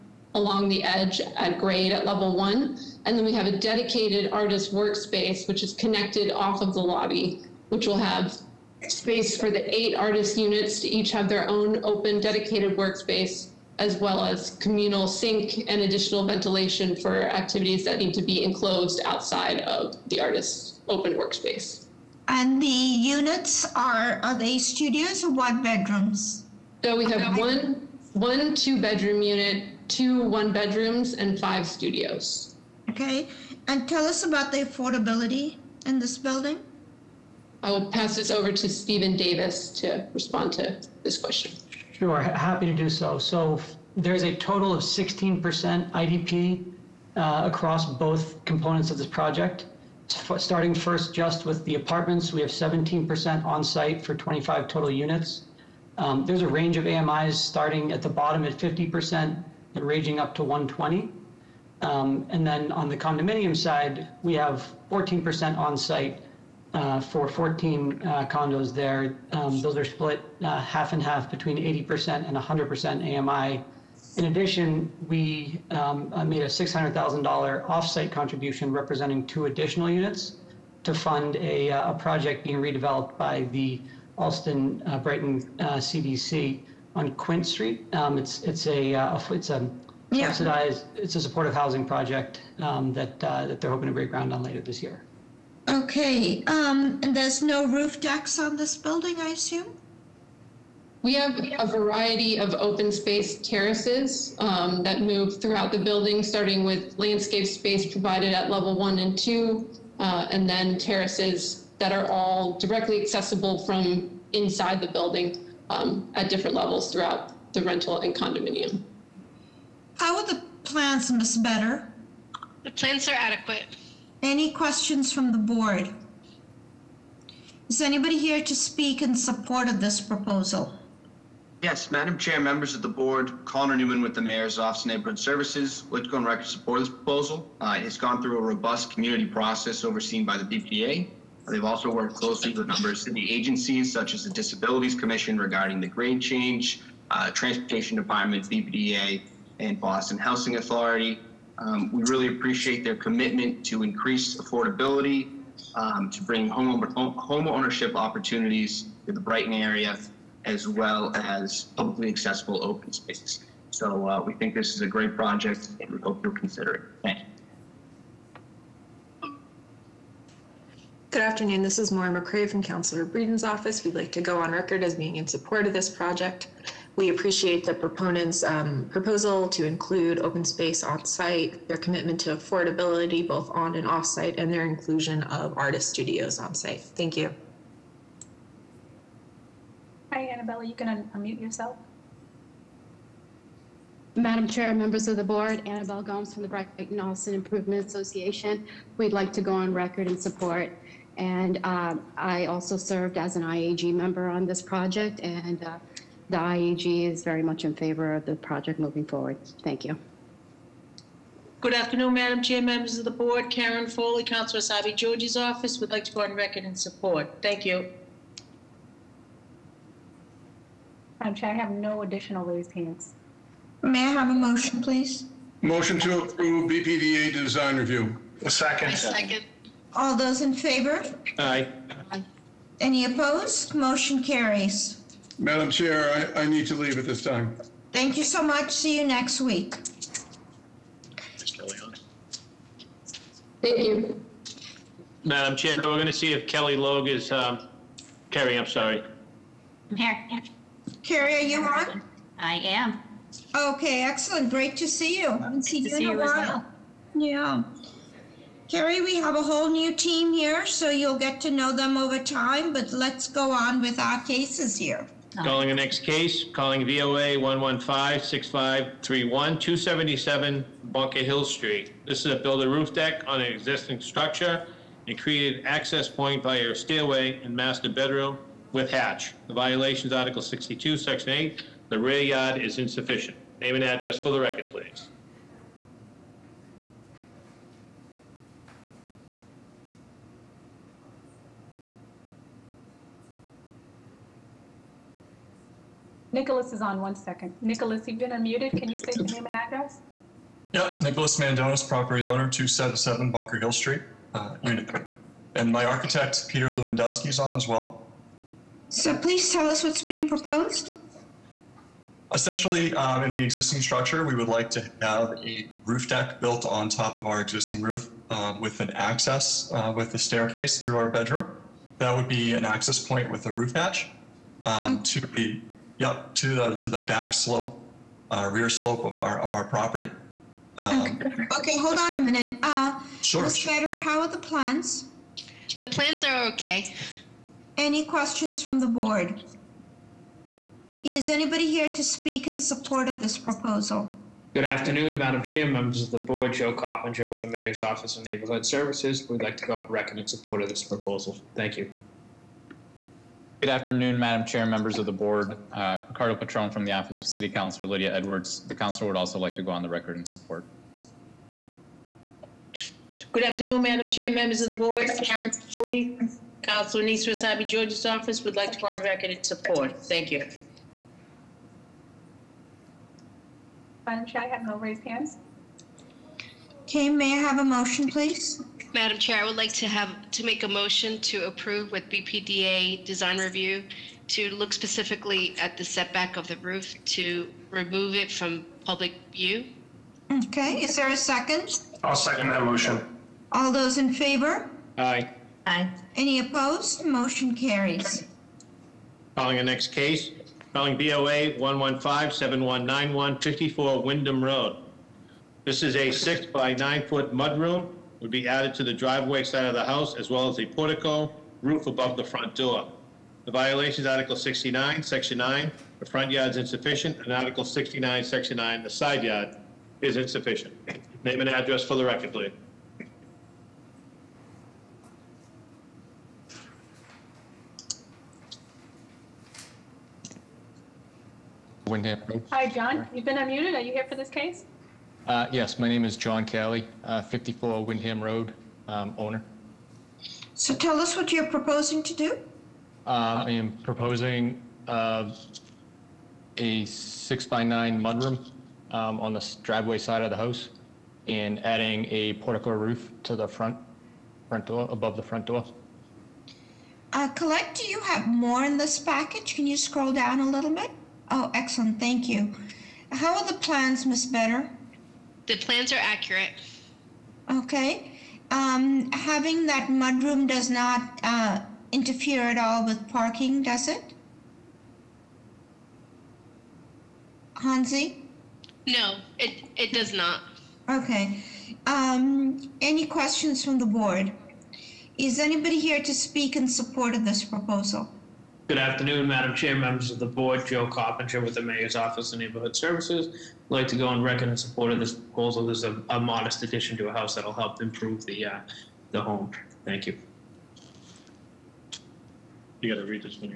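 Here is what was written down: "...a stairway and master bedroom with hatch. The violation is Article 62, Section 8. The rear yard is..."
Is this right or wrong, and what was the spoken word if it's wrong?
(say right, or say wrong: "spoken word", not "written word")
right.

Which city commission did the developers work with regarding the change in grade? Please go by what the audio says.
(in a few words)
Disabilities Commission.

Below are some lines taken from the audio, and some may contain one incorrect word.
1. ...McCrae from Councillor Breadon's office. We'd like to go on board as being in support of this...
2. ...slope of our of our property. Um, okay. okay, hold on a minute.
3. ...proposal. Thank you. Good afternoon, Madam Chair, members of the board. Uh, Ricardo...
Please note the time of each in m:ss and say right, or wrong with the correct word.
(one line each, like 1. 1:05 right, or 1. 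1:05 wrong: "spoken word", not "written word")
1. 2:52 wrong: "record", not "board"
2. 5:28 right
3. 5:50 right.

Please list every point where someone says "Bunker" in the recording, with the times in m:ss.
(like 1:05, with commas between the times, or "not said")
4:30, 5:03.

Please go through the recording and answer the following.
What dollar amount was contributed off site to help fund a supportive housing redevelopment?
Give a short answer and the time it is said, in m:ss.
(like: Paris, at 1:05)
$600,000, at 1:16.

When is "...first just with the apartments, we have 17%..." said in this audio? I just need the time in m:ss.
0:50.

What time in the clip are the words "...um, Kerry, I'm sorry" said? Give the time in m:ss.
4:07.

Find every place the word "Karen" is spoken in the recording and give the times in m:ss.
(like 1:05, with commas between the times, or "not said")
3:33, 6:05.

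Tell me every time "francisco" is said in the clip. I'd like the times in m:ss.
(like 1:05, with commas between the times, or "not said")
not said.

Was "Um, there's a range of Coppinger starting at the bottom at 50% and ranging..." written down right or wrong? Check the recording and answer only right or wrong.
wrong.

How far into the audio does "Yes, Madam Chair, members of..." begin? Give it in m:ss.
2:11.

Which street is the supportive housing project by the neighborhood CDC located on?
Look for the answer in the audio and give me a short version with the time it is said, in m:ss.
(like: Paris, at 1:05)
Quint Street, at 1:27.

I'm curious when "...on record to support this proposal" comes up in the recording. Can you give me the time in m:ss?
2:16.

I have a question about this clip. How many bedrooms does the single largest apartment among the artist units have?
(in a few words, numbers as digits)
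2.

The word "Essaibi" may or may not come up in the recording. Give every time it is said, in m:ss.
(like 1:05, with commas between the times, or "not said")
3:34, 6:07.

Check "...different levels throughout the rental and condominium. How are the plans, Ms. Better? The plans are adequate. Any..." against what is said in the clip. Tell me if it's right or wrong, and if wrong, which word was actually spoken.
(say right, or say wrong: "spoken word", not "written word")
right.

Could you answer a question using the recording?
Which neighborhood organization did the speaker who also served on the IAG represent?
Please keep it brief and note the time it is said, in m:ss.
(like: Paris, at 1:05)
Brighton Allston Improvement Association, at 3:16.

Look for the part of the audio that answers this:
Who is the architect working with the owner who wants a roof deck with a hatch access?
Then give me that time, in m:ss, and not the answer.
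5:06.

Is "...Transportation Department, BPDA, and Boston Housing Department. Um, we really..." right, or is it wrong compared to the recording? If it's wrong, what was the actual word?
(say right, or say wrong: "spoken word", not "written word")
wrong: "Authority", not "Department".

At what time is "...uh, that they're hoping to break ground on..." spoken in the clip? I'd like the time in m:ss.
1:33.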